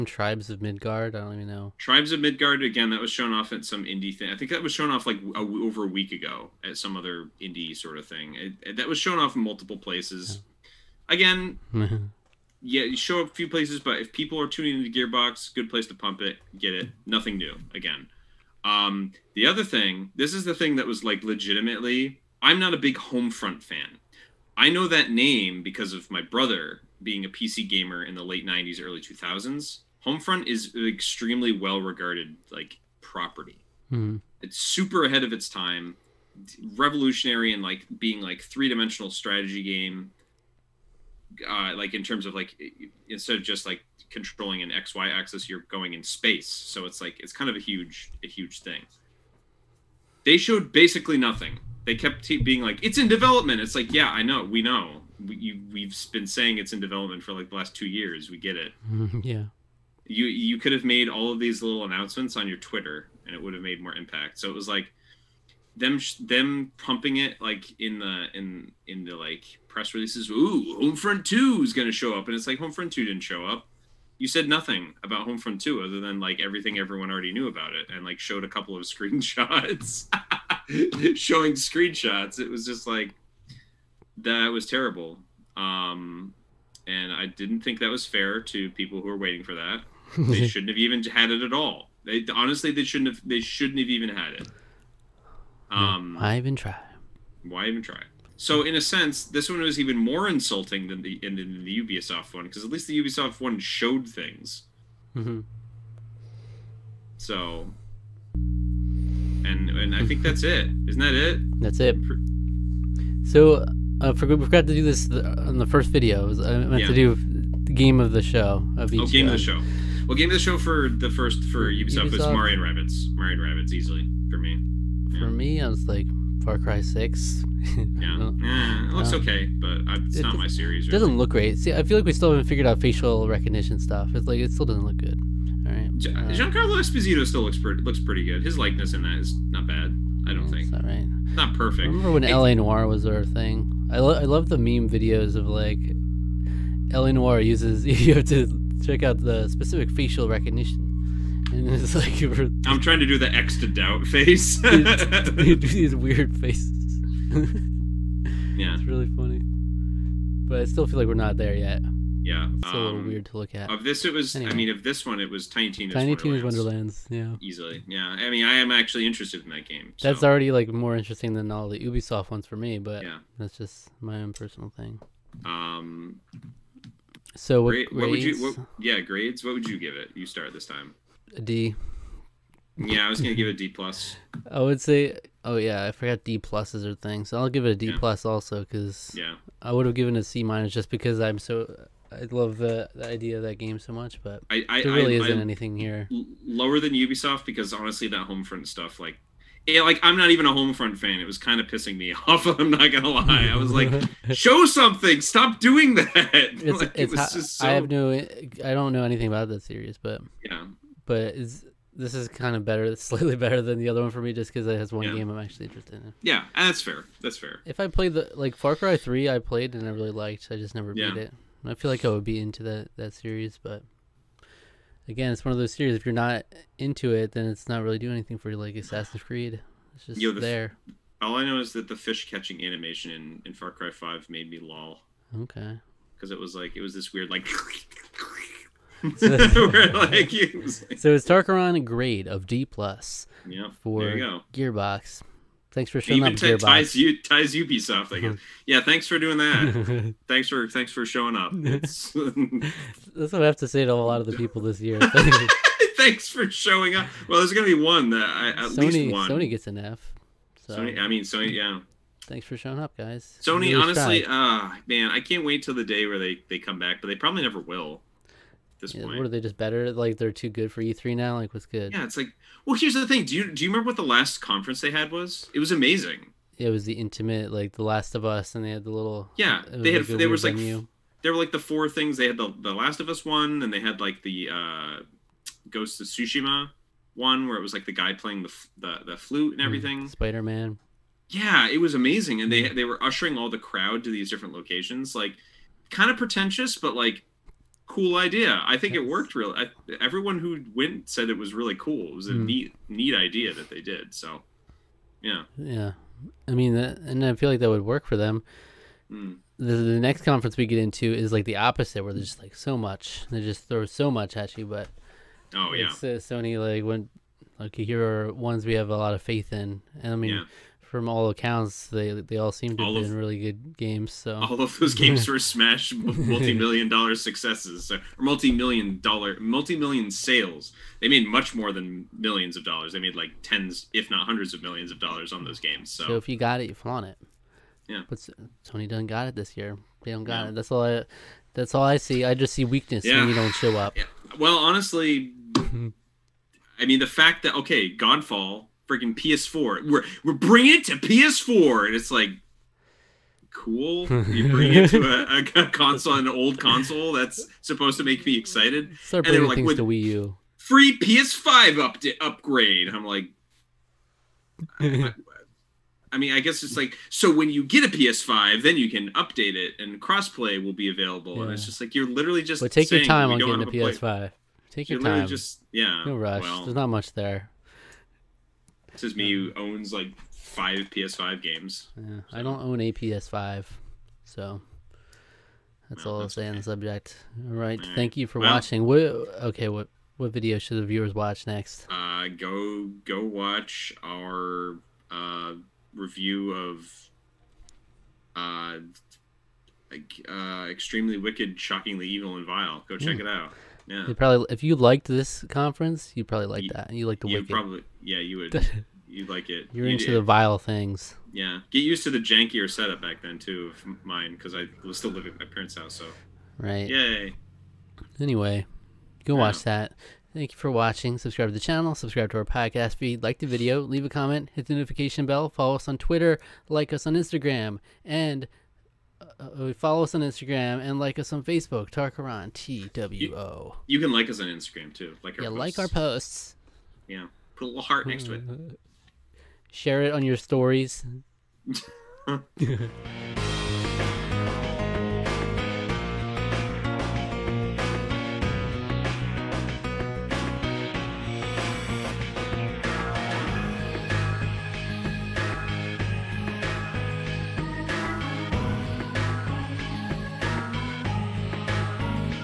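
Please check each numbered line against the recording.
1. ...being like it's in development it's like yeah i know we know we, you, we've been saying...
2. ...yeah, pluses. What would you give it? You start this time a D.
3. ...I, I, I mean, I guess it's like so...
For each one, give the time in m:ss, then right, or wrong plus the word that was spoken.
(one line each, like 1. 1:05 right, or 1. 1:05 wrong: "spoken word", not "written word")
1. 0:52 right
2. 2:58 wrong: "grades", not "pluses"
3. 6:04 right.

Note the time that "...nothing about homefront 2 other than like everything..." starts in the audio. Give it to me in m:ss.
1:14.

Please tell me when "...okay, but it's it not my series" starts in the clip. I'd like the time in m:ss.
2:09.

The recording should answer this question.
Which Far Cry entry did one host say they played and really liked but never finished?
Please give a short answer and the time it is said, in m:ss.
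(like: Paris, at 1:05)
Far Cry 3, at 3:38.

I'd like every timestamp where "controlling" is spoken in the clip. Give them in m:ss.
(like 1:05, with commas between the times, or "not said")
0:44.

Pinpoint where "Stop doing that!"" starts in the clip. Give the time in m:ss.
3:25.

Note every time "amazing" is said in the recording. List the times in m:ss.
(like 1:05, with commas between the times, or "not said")
4:35, 4:51.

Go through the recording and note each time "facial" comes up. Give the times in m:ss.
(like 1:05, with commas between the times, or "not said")
2:12, 2:29.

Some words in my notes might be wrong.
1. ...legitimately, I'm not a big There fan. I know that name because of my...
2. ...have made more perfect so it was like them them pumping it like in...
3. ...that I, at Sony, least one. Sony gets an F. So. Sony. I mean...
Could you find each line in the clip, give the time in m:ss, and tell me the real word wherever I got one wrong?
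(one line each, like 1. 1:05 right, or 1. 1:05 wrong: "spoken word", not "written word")
1. 0:21 wrong: "Homefront", not "There"
2. 1:03 wrong: "impact", not "perfect"
3. 4:18 right.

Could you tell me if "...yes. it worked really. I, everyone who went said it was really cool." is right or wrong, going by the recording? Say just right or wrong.
right.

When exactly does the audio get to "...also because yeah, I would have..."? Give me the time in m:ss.
3:08.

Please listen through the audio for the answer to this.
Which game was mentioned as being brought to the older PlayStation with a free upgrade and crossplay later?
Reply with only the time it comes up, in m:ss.
5:47.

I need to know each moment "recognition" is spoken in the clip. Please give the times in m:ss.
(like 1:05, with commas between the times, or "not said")
2:13, 2:30.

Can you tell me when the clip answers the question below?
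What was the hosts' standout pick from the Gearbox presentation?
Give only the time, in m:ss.
2:45.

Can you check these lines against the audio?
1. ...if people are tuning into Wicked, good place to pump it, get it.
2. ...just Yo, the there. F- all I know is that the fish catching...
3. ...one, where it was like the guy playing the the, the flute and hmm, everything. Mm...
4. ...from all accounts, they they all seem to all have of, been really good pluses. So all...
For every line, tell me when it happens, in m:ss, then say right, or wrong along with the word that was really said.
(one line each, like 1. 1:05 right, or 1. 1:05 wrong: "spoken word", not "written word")
1. 0:13 wrong: "Gearbox", not "Wicked"
2. 3:50 right
3. 4:47 right
4. 5:20 wrong: "games", not "pluses".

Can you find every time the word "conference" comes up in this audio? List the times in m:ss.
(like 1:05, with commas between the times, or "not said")
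4:34, 5:10, 6:45.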